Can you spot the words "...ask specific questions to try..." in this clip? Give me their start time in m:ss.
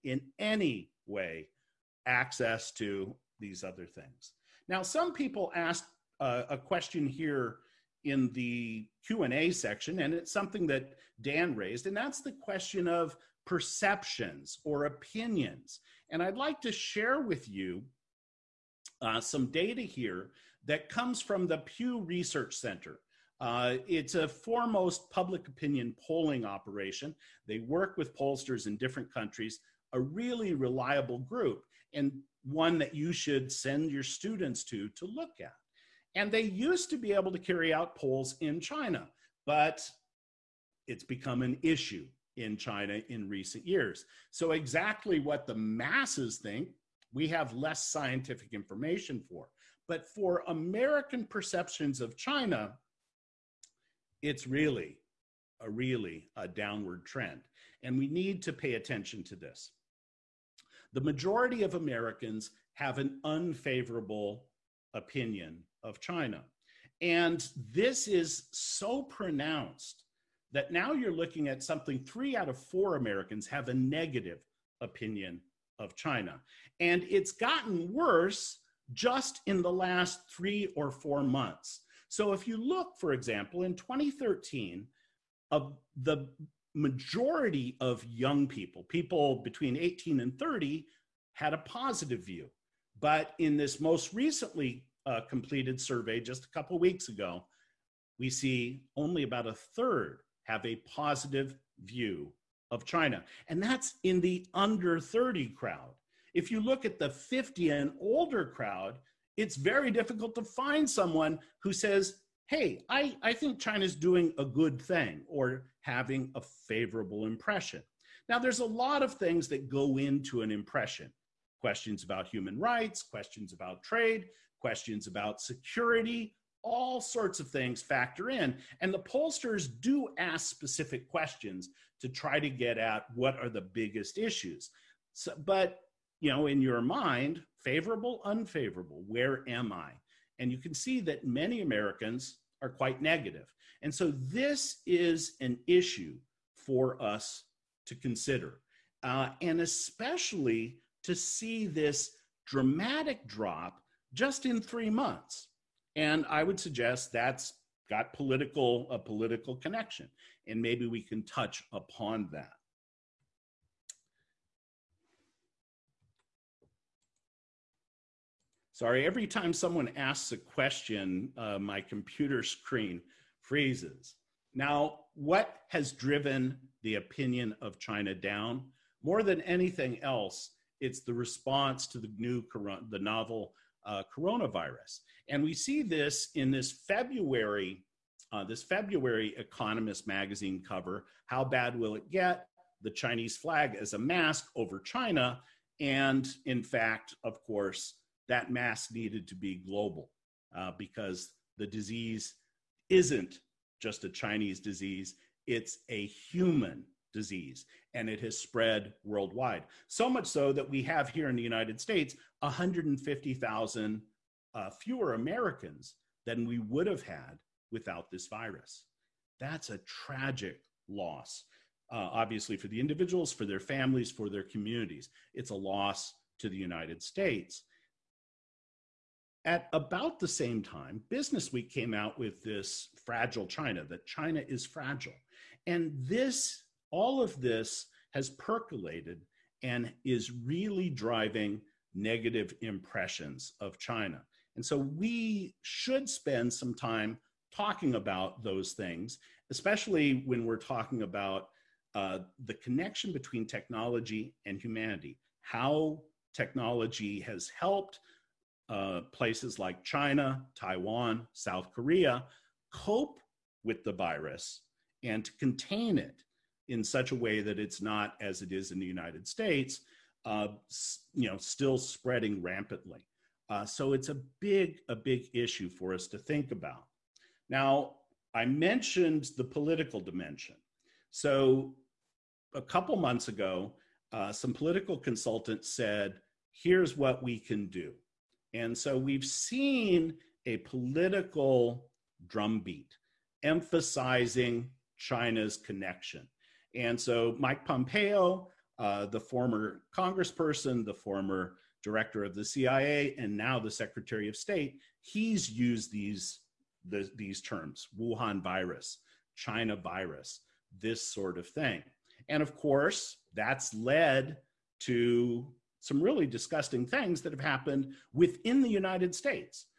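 2:10.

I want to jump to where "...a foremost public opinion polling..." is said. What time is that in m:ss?
0:24.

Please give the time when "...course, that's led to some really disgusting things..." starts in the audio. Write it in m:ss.
5:12.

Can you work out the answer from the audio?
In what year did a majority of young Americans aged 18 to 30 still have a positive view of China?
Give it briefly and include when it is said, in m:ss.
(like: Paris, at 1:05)
2013, at 1:23.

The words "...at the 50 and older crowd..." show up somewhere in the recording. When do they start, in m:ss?
1:46.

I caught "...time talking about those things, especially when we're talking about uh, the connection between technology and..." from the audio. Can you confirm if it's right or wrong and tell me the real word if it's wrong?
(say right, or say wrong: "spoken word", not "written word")
right.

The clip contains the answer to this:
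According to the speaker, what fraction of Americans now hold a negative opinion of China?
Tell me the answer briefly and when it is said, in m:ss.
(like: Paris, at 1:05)
3 out of 4, at 1:11.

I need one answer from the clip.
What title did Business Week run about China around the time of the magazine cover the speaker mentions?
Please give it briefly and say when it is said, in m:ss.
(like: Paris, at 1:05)
Fragile China, at 3:53.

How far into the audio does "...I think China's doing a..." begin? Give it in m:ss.
1:53.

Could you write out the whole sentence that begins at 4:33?
Uh, so it's a big, a big issue for us to think about.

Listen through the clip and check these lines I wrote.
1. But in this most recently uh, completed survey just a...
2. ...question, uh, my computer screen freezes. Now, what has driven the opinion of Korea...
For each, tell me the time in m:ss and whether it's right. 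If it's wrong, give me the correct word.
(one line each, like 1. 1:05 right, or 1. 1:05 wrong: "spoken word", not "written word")
1. 1:33 right
2. 2:50 wrong: "China", not "Korea".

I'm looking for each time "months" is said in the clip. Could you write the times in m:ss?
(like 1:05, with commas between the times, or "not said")
1:21, 2:34, 4:42.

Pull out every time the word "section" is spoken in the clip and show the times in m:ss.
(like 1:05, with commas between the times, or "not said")
0:09.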